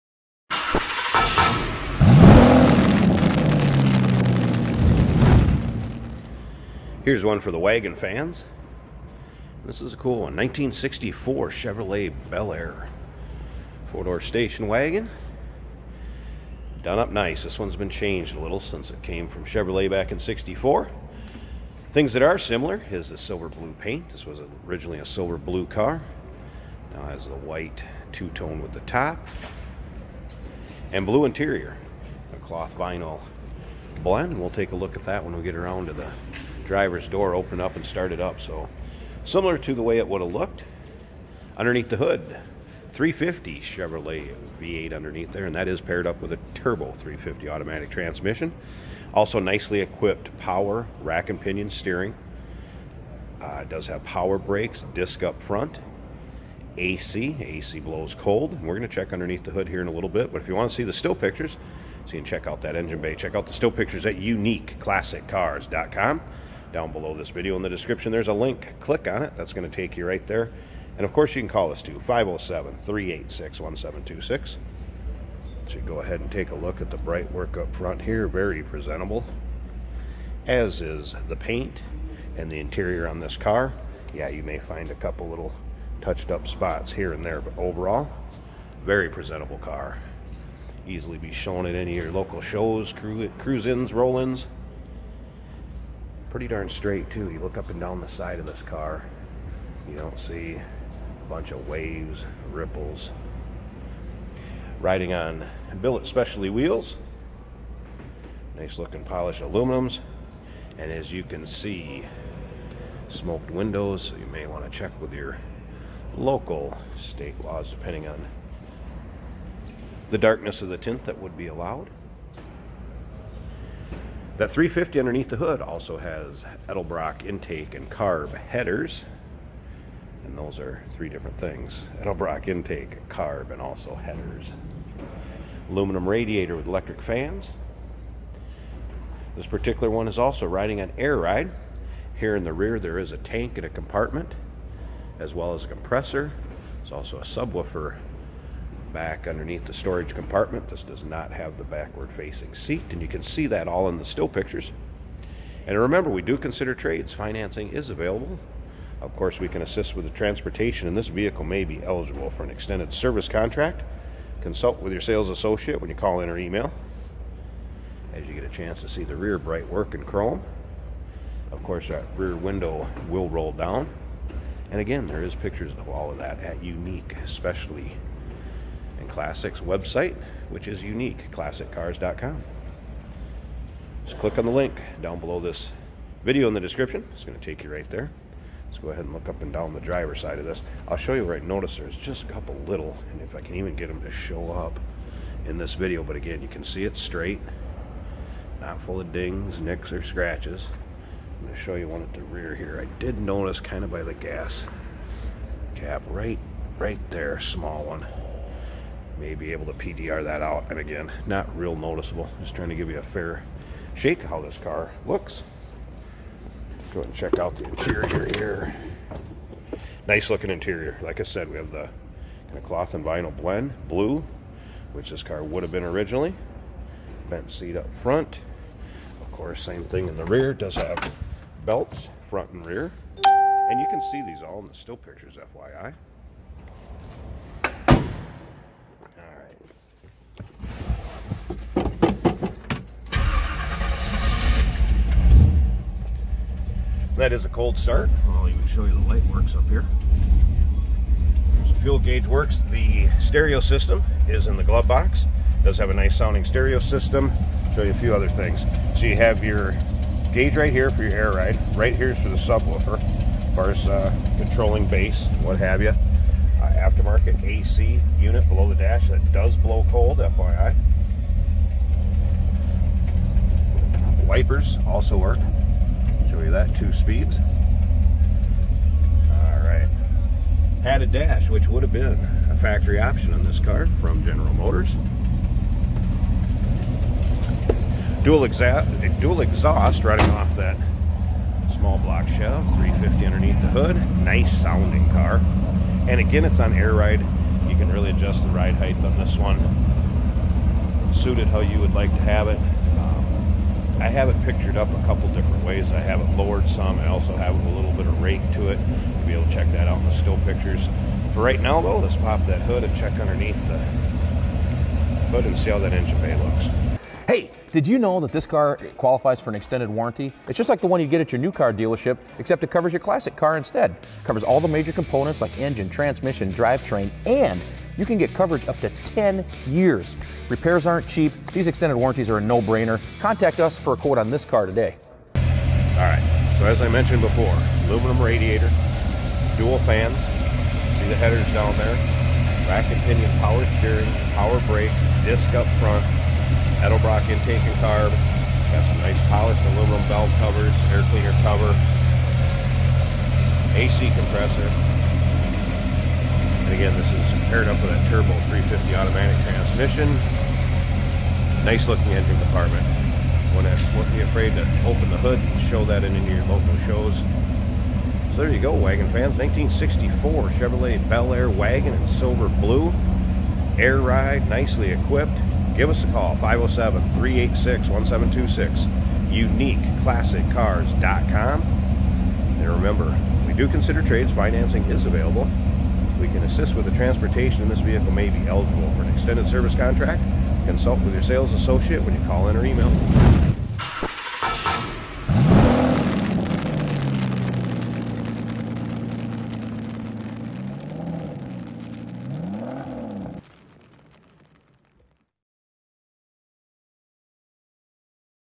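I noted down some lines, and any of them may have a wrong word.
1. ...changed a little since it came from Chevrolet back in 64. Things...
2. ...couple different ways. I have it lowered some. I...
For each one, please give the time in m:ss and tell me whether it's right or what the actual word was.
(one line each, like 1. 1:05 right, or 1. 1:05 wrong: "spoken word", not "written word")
1. 0:17 right
2. 5:05 right.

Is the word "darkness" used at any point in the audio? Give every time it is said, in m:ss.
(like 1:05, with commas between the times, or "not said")
2:00.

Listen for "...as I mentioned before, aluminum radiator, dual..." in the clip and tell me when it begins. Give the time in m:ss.
5:36.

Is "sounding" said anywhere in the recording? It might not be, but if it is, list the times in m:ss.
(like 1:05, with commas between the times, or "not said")
4:16, 4:54.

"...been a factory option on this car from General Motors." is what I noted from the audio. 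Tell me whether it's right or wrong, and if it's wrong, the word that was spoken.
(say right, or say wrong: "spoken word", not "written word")
right.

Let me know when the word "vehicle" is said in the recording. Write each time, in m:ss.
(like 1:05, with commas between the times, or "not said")
2:41, 6:27.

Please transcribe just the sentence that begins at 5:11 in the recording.
For right now, though, let's pop that hood and check underneath the hood and see how that engine bay looks.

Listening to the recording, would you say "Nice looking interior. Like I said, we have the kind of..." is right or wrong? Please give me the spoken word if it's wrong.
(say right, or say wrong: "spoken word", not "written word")
right.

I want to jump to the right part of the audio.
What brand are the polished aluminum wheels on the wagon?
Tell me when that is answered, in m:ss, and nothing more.
1:45.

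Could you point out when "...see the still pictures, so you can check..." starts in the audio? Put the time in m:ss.
1:00.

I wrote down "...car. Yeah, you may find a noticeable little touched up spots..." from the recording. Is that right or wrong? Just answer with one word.
wrong.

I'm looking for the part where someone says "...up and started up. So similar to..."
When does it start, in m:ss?
0:37.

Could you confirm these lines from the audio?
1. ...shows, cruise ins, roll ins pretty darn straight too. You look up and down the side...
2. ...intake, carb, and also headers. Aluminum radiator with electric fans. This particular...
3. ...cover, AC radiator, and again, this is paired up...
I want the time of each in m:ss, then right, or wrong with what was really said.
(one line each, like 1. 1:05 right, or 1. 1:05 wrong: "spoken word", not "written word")
1. 1:32 right
2. 2:12 right
3. 5:51 wrong: "compressor", not "radiator".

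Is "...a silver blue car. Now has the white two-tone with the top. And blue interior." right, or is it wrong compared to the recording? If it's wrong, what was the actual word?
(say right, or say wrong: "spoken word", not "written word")
right.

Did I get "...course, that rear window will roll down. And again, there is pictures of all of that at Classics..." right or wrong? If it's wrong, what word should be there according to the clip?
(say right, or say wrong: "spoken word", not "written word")
wrong: "Unique", not "Classics".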